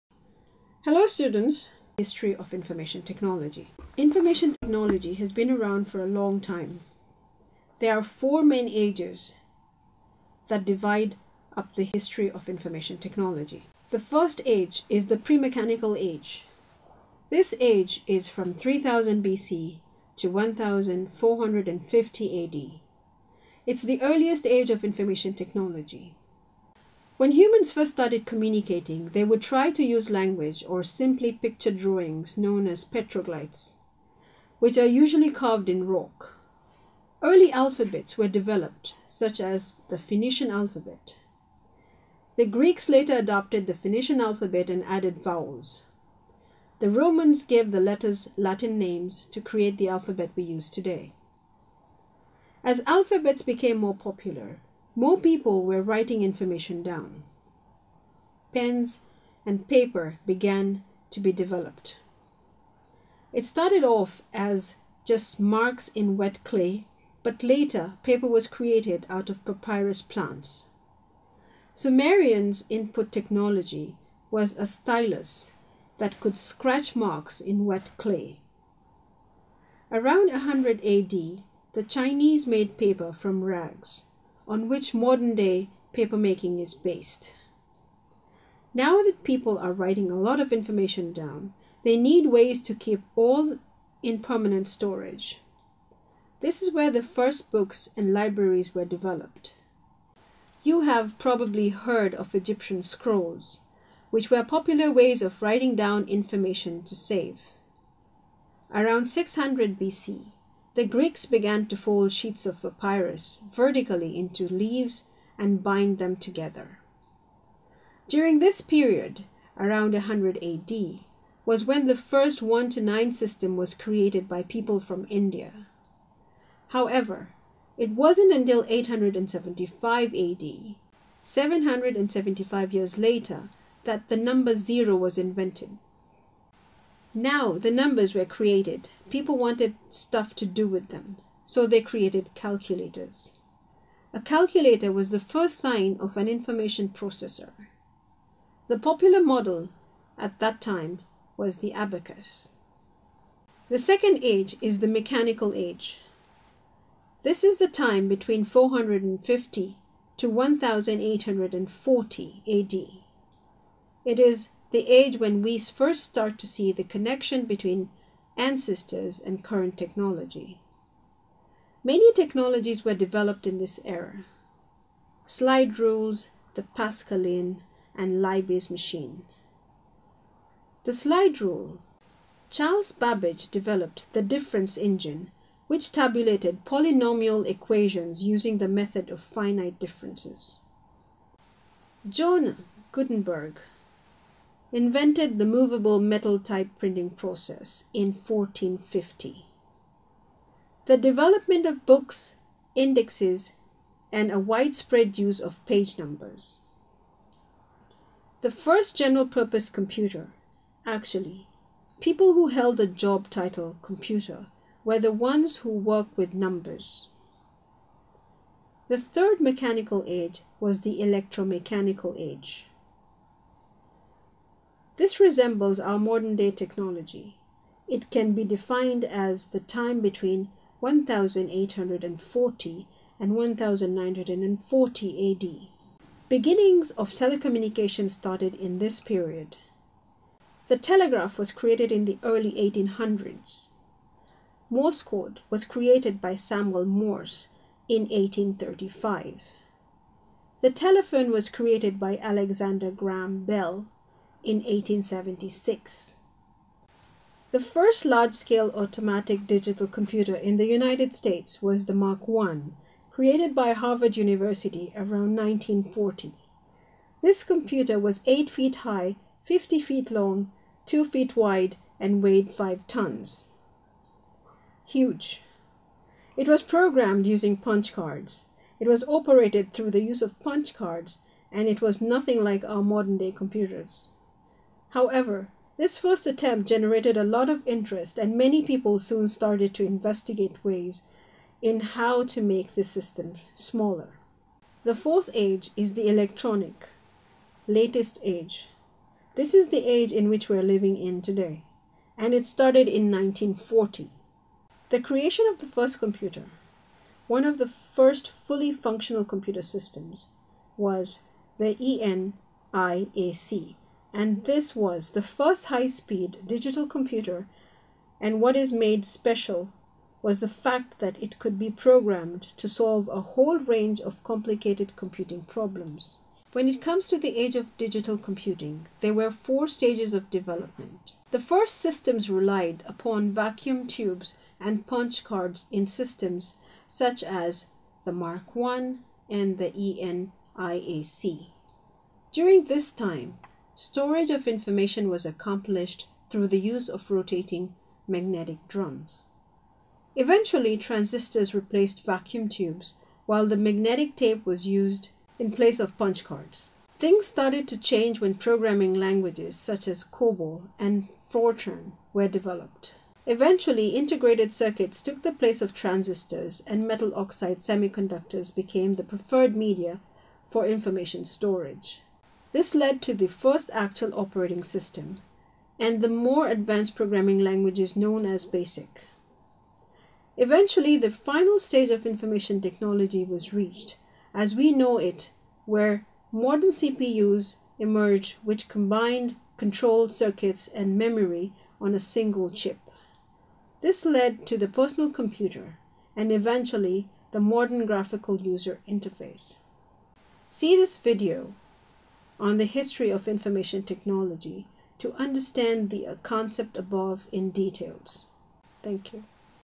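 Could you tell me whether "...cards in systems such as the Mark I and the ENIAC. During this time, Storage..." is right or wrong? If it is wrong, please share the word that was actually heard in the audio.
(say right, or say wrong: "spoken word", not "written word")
right.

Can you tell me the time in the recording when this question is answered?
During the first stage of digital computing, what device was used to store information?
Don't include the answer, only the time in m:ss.
5:47.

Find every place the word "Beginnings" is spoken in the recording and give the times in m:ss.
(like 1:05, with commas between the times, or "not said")
3:56.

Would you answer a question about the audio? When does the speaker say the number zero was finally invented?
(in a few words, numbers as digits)
875 AD.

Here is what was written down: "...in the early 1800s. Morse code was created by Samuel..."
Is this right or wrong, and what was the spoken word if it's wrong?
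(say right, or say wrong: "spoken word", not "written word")
right.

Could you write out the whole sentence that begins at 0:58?
Pens and paper began to be developed.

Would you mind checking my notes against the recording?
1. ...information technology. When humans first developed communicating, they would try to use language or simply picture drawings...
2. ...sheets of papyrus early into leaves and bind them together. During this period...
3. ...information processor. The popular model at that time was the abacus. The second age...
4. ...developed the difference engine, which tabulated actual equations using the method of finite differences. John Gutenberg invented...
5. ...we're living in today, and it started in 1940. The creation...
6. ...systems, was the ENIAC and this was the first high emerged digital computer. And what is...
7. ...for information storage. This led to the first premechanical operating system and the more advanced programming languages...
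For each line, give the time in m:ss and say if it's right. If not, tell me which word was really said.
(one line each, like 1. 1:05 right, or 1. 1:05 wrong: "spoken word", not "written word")
1. 0:24 wrong: "started", not "developed"
2. 1:52 wrong: "vertically", not "early"
3. 2:26 right
4. 3:03 wrong: "polynomial", not "actual"
5. 5:00 right
6. 5:09 wrong: "speed", not "emerged"
7. 6:10 wrong: "actual", not "premechanical".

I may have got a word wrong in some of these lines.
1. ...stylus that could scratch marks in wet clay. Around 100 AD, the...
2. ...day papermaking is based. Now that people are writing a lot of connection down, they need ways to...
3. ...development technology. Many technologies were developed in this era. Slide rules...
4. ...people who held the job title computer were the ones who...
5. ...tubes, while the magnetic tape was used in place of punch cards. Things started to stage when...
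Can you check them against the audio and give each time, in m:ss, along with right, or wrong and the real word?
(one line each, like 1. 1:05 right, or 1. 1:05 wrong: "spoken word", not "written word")
1. 1:14 right
2. 1:25 wrong: "information", not "connection"
3. 2:49 wrong: "current", not "development"
4. 3:31 right
5. 5:52 wrong: "change", not "stage".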